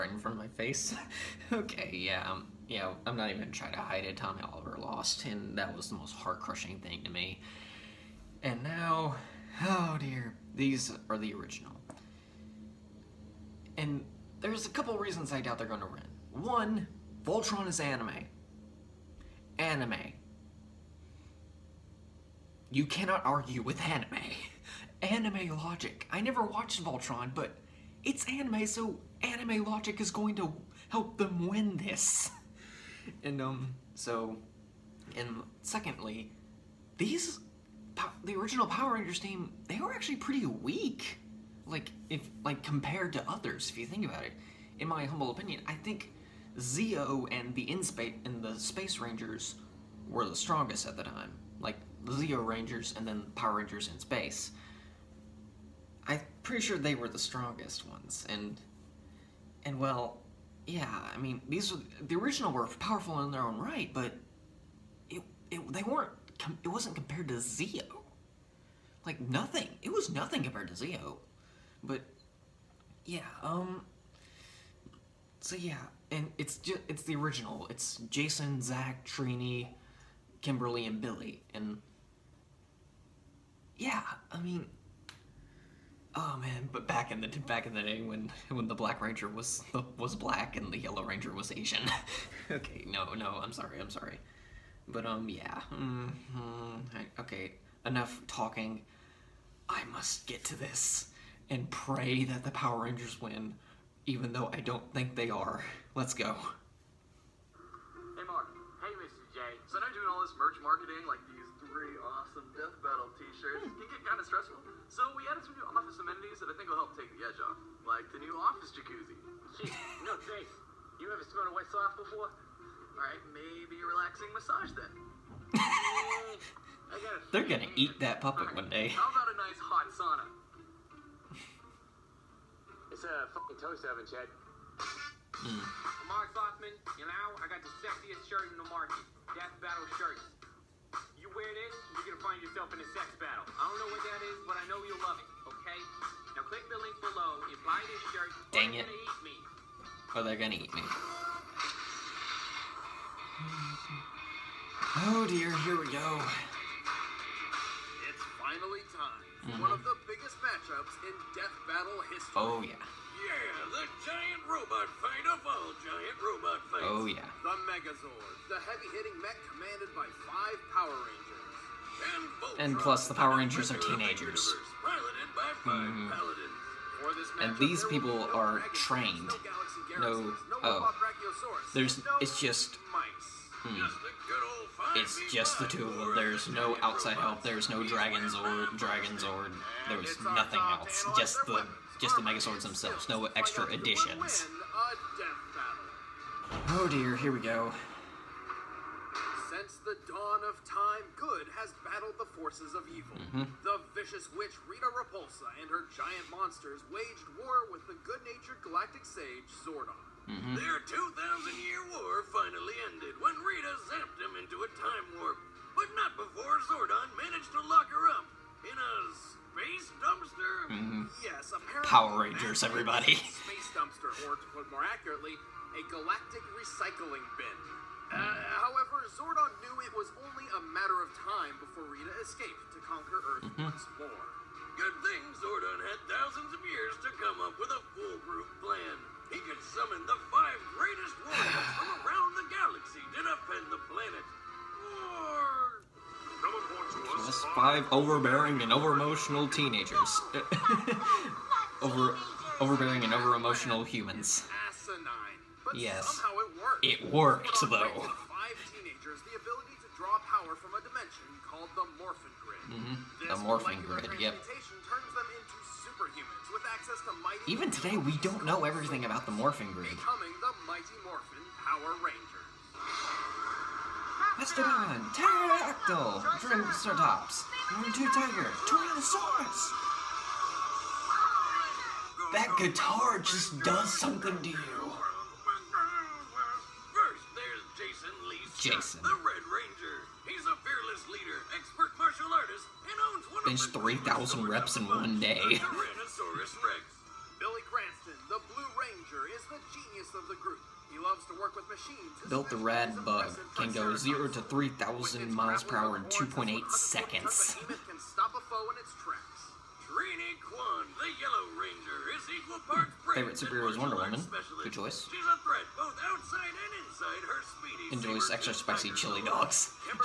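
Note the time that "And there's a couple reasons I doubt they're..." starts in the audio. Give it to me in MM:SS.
00:13.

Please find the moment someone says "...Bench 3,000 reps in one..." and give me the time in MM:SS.
04:53.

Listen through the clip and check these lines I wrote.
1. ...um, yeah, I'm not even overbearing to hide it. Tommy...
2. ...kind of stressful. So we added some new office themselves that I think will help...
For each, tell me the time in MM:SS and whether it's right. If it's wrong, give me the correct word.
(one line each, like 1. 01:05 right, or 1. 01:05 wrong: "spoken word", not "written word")
1. 00:02 wrong: "trying", not "overbearing"
2. 01:54 wrong: "amenities", not "themselves".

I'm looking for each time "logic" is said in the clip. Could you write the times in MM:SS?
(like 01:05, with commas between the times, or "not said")
00:25, 00:29.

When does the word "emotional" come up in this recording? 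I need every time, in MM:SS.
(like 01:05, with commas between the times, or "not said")
04:08, 04:13.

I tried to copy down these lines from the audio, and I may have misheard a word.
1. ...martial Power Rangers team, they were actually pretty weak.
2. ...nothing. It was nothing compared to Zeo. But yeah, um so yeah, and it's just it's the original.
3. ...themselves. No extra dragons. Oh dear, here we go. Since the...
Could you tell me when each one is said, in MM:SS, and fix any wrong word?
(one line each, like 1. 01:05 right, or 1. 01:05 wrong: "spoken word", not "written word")
1. 00:38 wrong: "original", not "martial"
2. 01:09 right
3. 03:12 wrong: "additions", not "dragons".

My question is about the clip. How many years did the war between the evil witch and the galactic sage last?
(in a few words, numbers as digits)
2,000.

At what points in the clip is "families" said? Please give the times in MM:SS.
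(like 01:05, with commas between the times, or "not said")
not said.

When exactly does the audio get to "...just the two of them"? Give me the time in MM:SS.
03:05.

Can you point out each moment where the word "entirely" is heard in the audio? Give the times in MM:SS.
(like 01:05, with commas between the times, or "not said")
not said.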